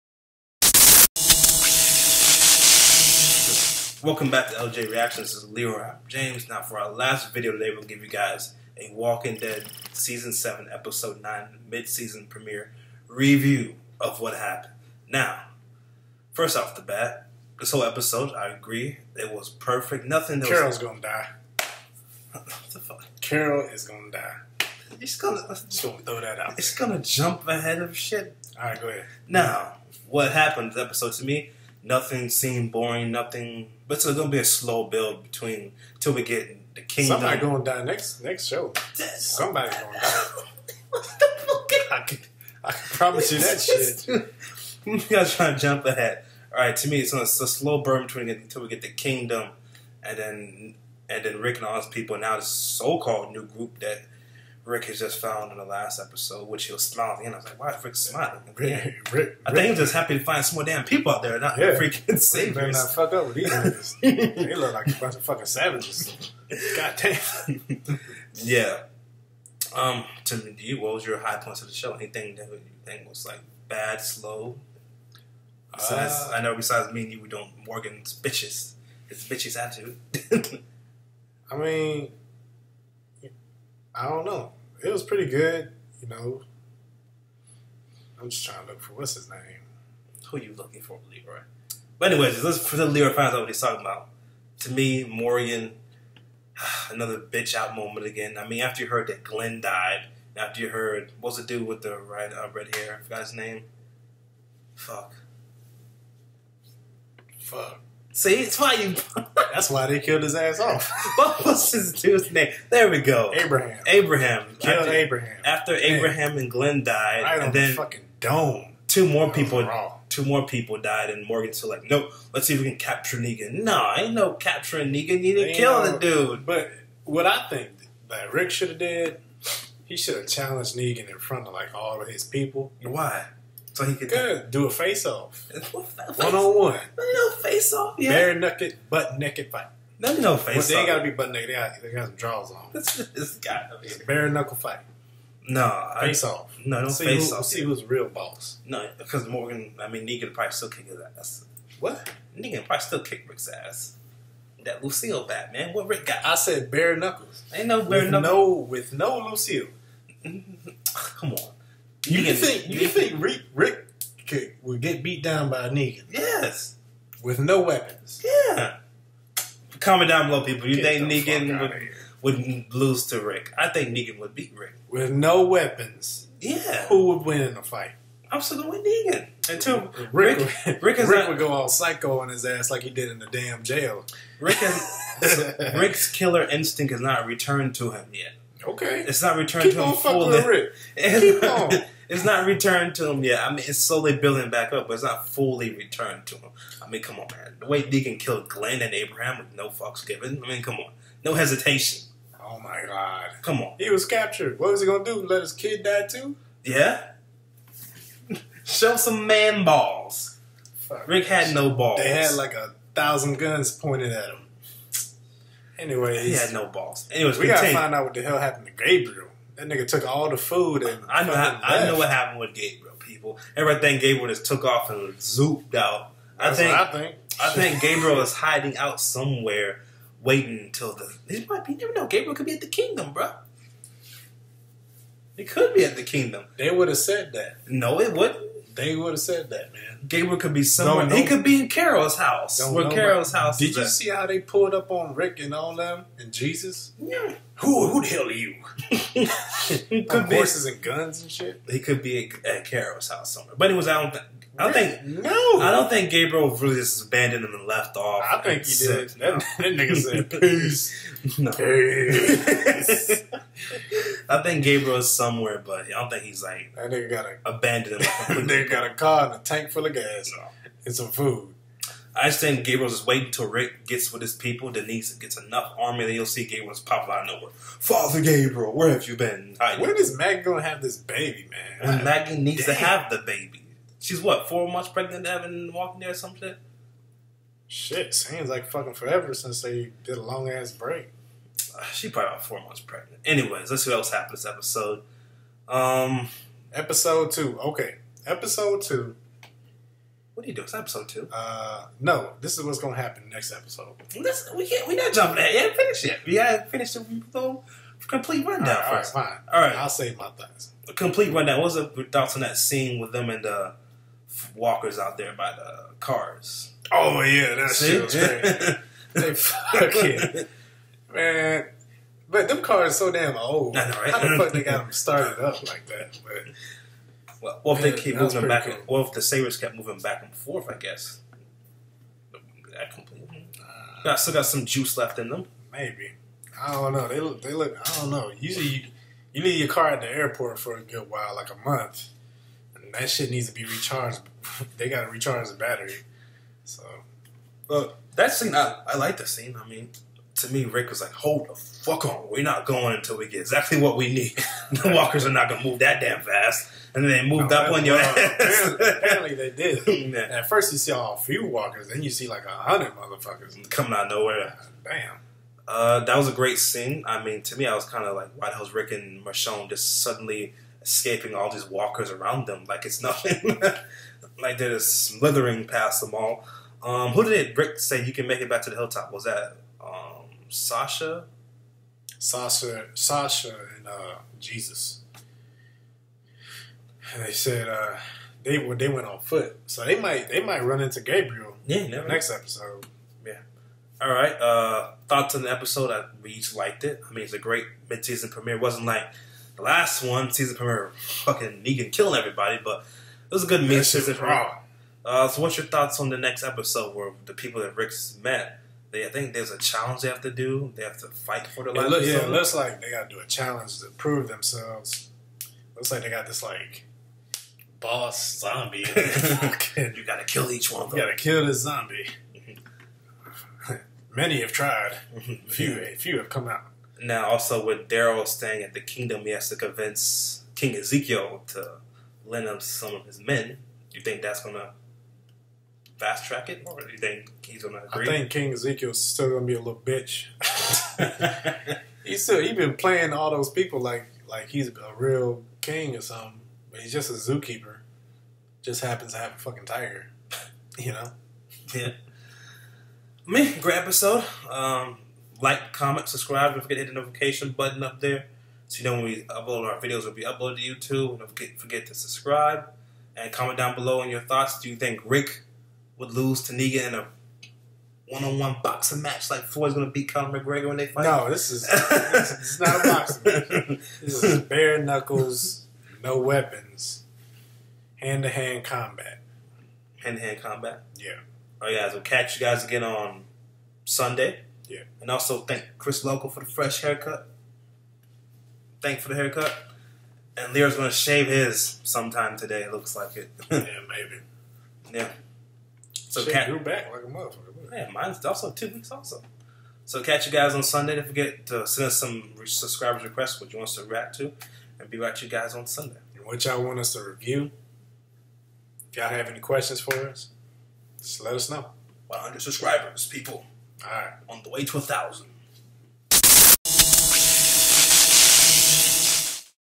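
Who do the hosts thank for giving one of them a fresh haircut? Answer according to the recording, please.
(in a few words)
Chris Local.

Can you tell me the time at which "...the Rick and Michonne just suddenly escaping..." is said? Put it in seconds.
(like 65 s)
368 s.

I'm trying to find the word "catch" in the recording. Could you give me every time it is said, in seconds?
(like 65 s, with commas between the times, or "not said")
482 s, 500 s.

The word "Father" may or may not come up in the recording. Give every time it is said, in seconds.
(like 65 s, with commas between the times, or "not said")
277 s.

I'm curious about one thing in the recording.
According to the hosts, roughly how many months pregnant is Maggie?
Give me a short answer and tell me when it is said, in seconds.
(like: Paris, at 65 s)
4 months, at 284 s.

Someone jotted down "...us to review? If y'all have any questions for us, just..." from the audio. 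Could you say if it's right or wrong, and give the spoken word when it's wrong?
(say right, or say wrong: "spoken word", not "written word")
right.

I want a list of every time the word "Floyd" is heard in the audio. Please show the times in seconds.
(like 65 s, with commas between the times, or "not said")
469 s.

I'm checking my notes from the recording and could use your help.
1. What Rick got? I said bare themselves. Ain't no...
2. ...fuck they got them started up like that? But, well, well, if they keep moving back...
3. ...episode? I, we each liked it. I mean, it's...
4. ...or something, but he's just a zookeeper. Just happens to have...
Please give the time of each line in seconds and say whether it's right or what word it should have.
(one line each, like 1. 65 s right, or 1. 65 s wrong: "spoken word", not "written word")
1. 155 s wrong: "knuckles", not "themselves"
2. 324 s right
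3. 395 s right
4. 445 s right.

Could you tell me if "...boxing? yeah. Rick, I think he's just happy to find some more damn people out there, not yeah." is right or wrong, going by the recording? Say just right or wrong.
wrong.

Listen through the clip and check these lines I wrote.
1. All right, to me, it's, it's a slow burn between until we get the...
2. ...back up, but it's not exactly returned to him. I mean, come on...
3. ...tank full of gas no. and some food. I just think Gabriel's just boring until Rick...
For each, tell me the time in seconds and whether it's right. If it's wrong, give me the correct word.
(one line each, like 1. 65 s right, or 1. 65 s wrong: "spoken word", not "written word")
1. 46 s right
2. 194 s wrong: "fully", not "exactly"
3. 269 s wrong: "waiting", not "boring".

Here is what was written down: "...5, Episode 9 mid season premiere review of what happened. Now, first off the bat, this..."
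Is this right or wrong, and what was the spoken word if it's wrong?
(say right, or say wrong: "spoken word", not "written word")
wrong: "7", not "5".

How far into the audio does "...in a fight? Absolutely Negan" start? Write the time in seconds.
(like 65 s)
177 s.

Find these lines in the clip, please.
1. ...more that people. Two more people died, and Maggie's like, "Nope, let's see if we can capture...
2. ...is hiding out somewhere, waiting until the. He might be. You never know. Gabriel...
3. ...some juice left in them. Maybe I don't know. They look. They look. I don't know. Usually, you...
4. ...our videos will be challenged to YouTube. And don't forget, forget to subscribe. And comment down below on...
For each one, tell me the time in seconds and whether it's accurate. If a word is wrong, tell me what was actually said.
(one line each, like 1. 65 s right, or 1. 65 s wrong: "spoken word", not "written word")
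1. 119 s wrong: "Morgan", not "Maggie"
2. 228 s right
3. 334 s right
4. 459 s wrong: "uploaded", not "challenged".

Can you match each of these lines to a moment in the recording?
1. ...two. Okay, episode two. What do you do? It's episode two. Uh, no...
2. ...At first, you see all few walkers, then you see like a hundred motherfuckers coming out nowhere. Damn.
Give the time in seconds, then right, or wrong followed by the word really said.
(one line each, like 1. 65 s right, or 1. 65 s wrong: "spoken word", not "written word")
1. 297 s right
2. 360 s right.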